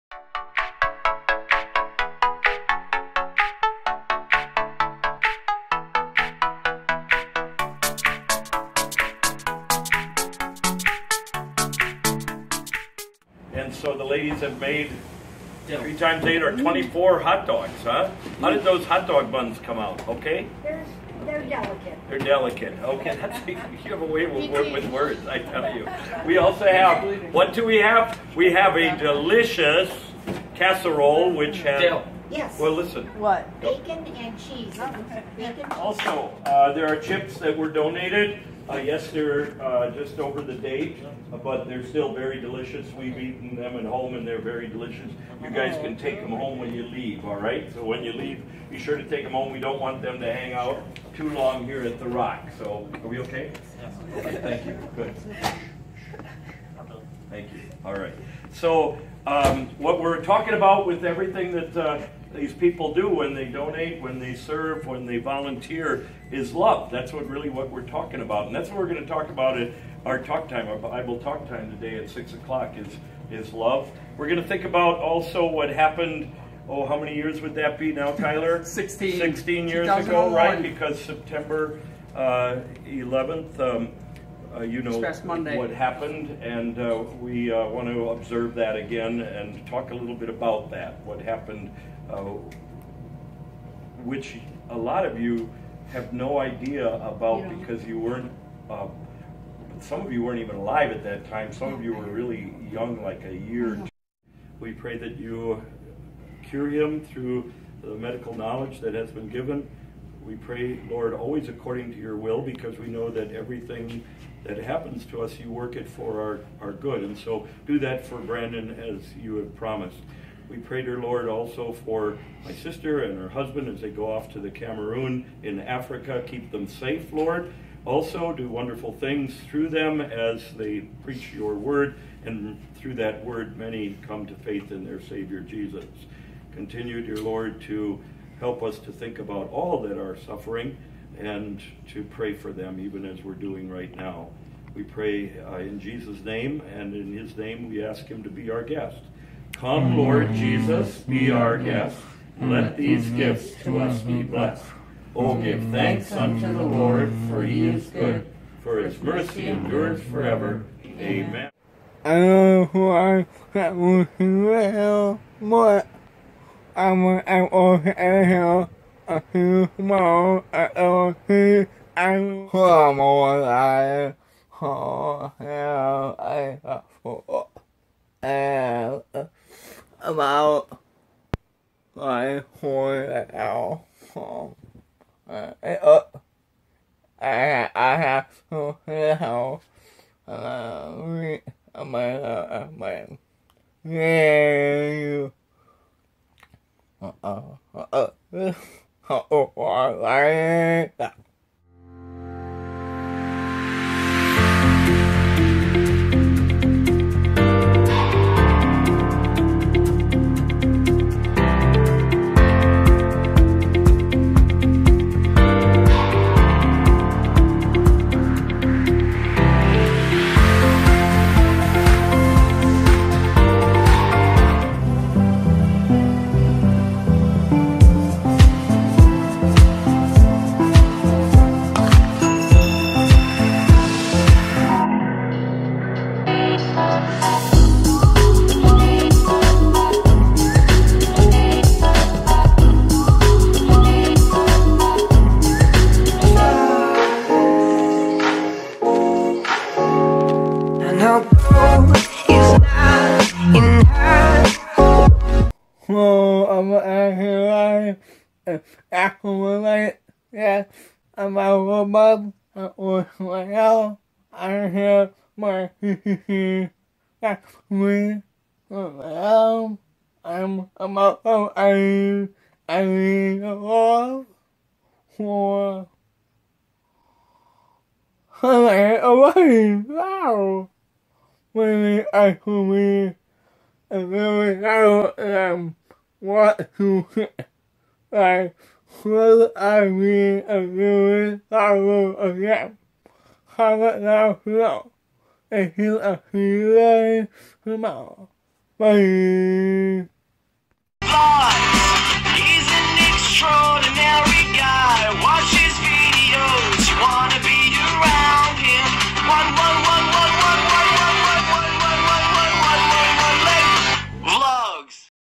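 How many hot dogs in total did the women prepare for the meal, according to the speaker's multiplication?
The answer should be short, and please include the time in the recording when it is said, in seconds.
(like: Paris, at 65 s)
24, at 16 s.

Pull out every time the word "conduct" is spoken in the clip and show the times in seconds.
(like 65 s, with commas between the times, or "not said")
not said.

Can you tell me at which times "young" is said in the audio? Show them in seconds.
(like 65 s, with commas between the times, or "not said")
102 s.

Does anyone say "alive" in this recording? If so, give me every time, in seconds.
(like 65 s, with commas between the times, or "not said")
100 s, 172 s.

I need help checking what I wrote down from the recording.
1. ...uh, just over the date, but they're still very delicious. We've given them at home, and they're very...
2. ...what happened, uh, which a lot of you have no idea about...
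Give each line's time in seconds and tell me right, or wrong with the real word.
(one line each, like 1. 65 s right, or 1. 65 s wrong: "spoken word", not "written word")
1. 39 s wrong: "eaten", not "given"
2. 91 s right.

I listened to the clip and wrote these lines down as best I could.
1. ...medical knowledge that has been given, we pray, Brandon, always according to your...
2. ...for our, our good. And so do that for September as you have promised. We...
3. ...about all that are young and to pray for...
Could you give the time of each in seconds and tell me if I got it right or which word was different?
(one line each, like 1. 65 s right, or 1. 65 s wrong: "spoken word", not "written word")
1. 107 s wrong: "Lord", not "Brandon"
2. 115 s wrong: "Brandon", not "September"
3. 139 s wrong: "suffering", not "young".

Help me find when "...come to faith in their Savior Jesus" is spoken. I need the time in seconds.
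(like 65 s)
134 s.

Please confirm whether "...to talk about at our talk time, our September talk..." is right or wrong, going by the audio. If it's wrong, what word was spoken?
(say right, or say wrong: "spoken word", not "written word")
wrong: "Bible", not "September".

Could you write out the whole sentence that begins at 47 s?
So when you leave, be sure to take them home.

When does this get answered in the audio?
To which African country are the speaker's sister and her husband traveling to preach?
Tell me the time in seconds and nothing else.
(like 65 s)
124 s.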